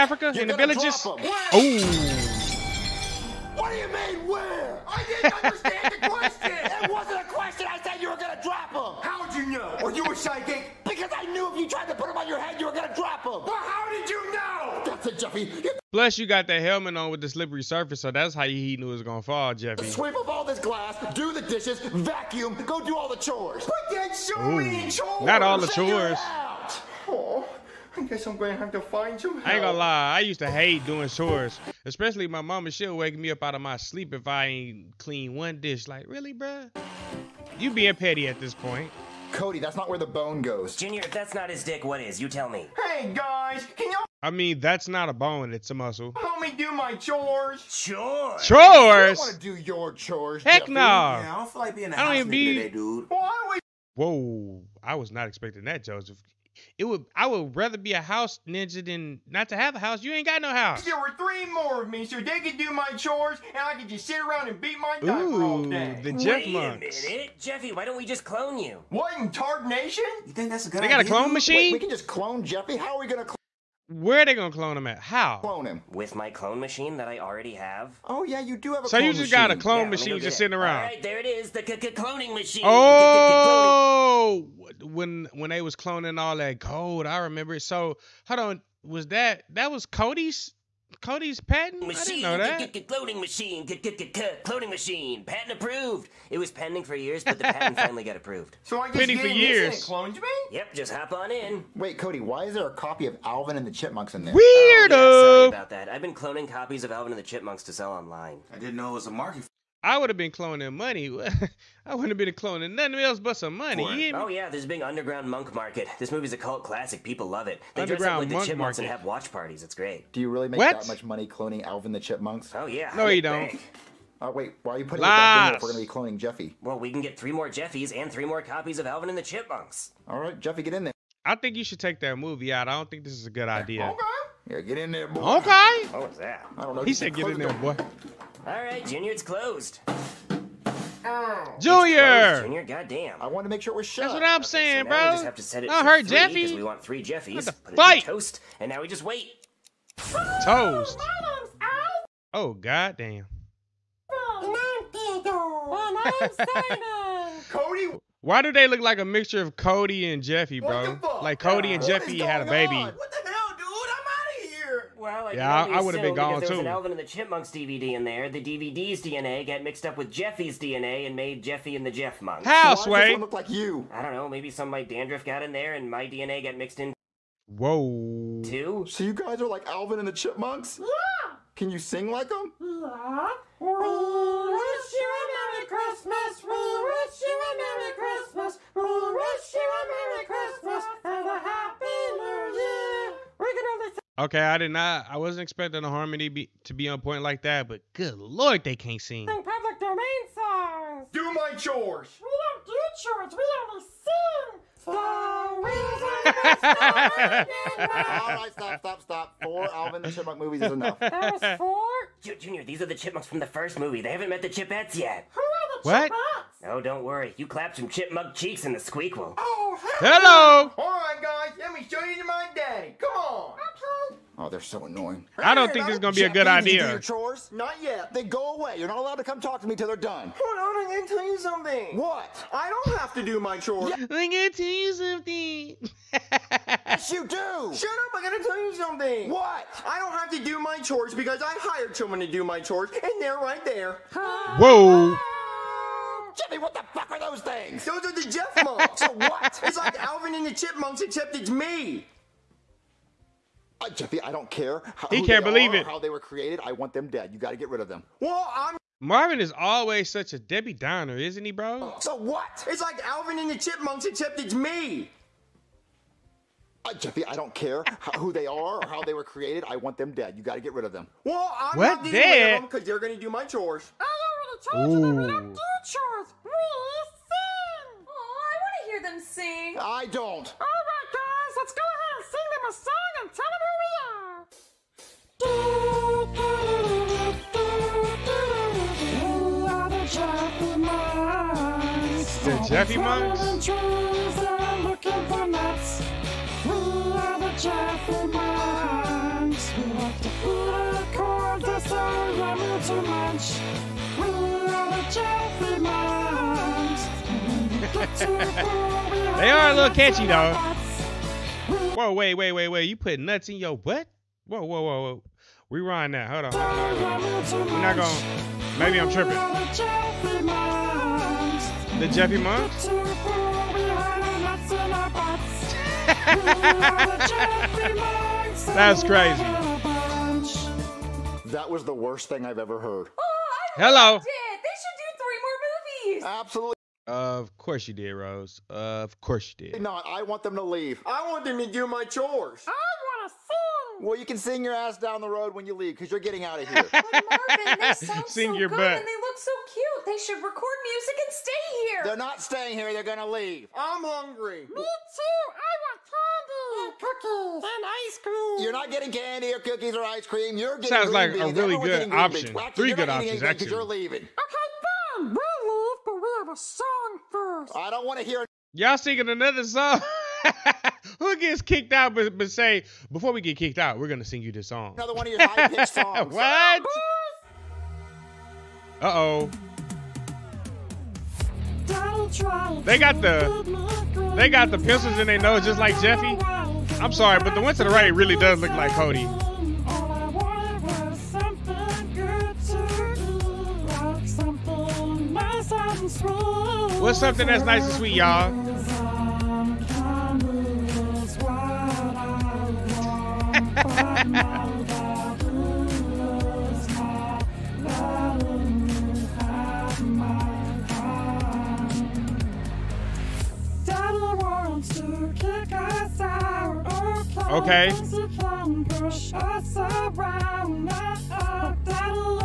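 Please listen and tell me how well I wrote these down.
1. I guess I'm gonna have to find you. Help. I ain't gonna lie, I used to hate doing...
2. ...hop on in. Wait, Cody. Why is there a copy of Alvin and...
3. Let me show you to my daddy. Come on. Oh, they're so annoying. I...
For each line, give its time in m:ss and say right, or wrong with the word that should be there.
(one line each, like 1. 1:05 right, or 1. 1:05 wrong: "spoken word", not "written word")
1. 0:27 right
2. 1:40 right
3. 3:41 right.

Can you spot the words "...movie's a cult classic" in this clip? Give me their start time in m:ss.
1:56.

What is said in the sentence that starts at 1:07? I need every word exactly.
Why don't we just clone you?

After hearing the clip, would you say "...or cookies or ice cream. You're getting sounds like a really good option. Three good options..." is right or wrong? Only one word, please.
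right.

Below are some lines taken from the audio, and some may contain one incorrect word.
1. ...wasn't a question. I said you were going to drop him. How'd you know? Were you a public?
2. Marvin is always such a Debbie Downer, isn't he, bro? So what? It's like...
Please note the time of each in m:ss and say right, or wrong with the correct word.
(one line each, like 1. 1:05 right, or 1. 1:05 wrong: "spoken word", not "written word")
1. 0:06 wrong: "psychic", not "public"
2. 4:19 right.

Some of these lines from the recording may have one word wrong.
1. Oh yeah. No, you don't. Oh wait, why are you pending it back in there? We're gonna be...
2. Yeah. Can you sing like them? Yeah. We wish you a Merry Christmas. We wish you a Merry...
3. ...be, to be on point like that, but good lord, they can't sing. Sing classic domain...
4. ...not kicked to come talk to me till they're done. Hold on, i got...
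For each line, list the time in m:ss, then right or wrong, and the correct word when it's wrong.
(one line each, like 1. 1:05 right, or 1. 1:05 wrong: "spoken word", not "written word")
1. 2:02 wrong: "putting", not "pending"
2. 3:00 right
3. 3:16 wrong: "public", not "classic"
4. 3:48 wrong: "allowed", not "kicked".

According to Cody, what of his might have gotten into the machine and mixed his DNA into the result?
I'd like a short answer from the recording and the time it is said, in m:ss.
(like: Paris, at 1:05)
dandruff, at 2:54.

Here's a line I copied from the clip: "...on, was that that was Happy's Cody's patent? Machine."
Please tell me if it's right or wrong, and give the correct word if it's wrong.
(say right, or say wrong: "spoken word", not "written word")
wrong: "Cody", not "Happy".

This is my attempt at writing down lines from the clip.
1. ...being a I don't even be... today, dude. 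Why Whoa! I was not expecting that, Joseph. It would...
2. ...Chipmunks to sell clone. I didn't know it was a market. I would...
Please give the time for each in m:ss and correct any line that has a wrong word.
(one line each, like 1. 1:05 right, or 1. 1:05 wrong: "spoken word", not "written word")
1. 0:51 right
2. 1:47 wrong: "online", not "clone".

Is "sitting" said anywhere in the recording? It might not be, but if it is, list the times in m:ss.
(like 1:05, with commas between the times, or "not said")
1:20.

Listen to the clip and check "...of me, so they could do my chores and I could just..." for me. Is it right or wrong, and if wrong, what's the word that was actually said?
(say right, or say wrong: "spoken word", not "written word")
right.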